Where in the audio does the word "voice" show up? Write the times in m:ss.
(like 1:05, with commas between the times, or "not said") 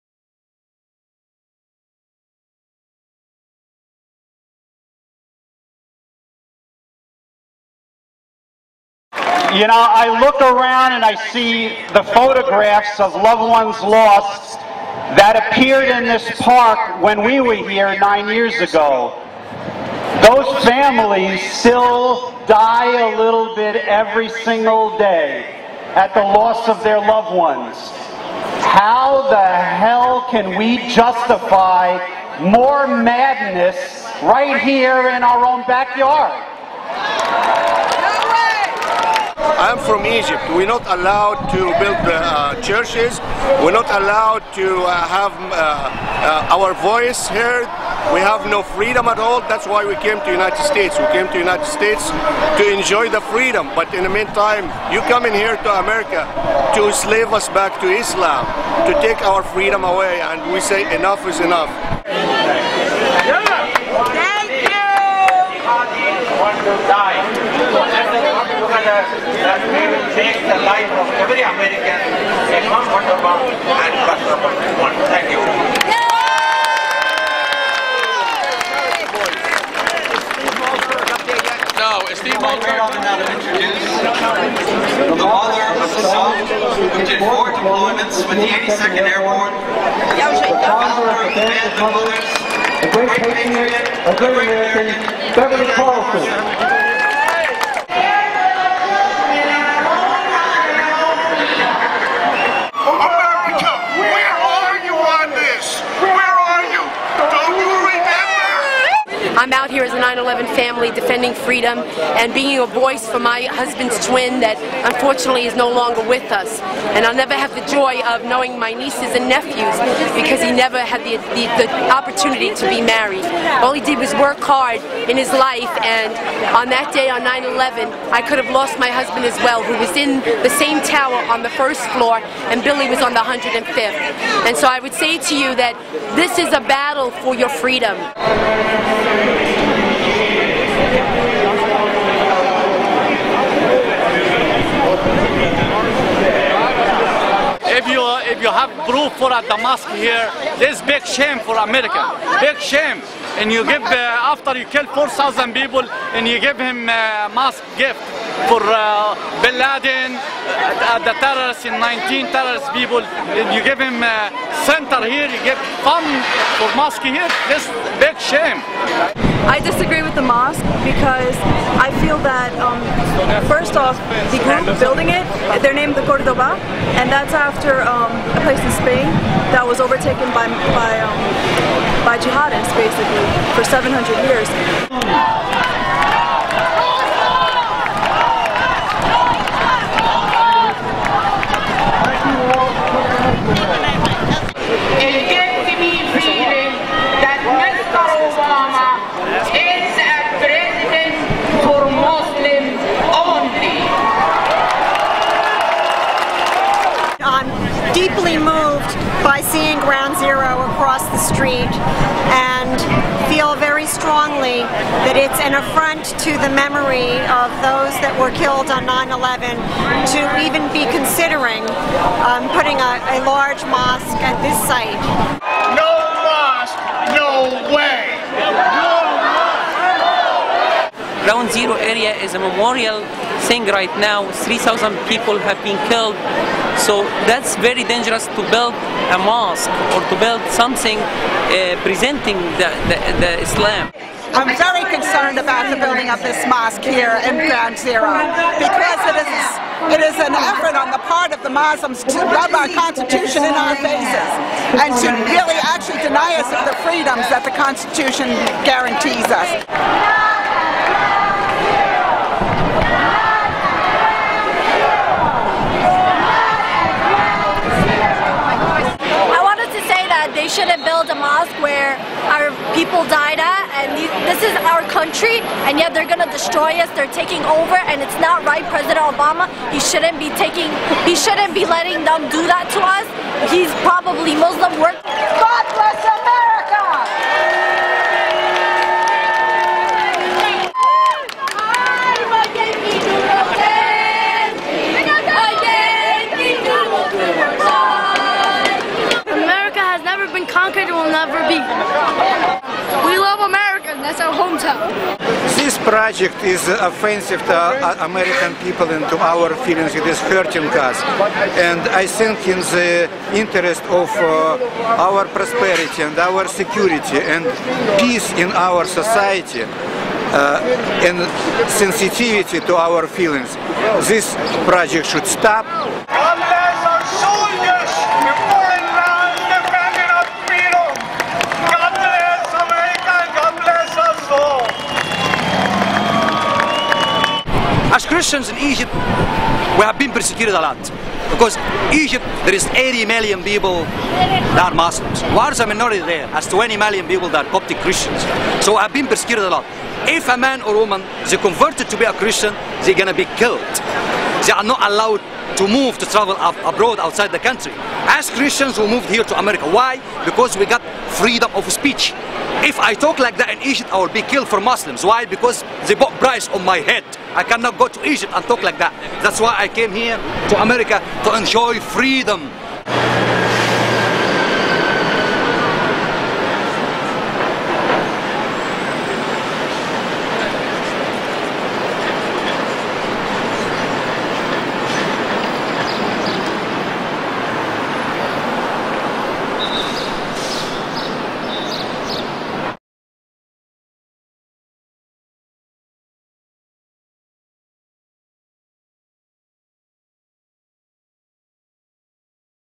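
0:46, 1:52.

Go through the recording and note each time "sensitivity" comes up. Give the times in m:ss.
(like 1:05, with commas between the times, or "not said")
5:21.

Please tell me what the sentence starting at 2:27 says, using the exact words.
If you, if you have proof for a Damask here, this big shame for America, big shame.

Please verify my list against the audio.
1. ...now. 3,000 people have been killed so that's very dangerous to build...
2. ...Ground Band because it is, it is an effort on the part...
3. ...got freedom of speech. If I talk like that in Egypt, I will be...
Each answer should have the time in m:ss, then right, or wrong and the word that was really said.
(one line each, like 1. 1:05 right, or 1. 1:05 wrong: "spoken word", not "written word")
1. 3:53 right
2. 4:07 wrong: "Zero", not "Band"
3. 6:00 right.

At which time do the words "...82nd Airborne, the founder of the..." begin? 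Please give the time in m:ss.
1:28.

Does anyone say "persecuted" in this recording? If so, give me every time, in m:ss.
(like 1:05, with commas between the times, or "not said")
5:40, 5:49.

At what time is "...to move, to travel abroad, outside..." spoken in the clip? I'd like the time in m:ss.
5:55.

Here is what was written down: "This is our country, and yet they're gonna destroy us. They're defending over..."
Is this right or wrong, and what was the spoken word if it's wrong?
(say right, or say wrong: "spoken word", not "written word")
wrong: "taking", not "defending".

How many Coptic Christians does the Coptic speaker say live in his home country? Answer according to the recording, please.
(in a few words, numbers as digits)
20 million.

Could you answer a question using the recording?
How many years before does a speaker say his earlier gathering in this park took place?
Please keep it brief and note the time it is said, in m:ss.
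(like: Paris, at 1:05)
9, at 0:17.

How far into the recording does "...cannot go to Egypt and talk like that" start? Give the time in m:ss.
6:07.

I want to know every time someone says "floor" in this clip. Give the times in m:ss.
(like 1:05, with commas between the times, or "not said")
2:11.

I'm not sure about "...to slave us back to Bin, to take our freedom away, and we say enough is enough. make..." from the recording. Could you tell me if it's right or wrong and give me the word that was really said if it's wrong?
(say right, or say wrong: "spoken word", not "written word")
wrong: "Islam", not "Bin".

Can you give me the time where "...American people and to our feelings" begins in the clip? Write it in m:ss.
5:08.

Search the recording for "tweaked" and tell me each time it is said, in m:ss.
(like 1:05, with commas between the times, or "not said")
not said.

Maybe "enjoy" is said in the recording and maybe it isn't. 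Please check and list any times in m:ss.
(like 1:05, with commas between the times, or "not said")
0:52, 6:11.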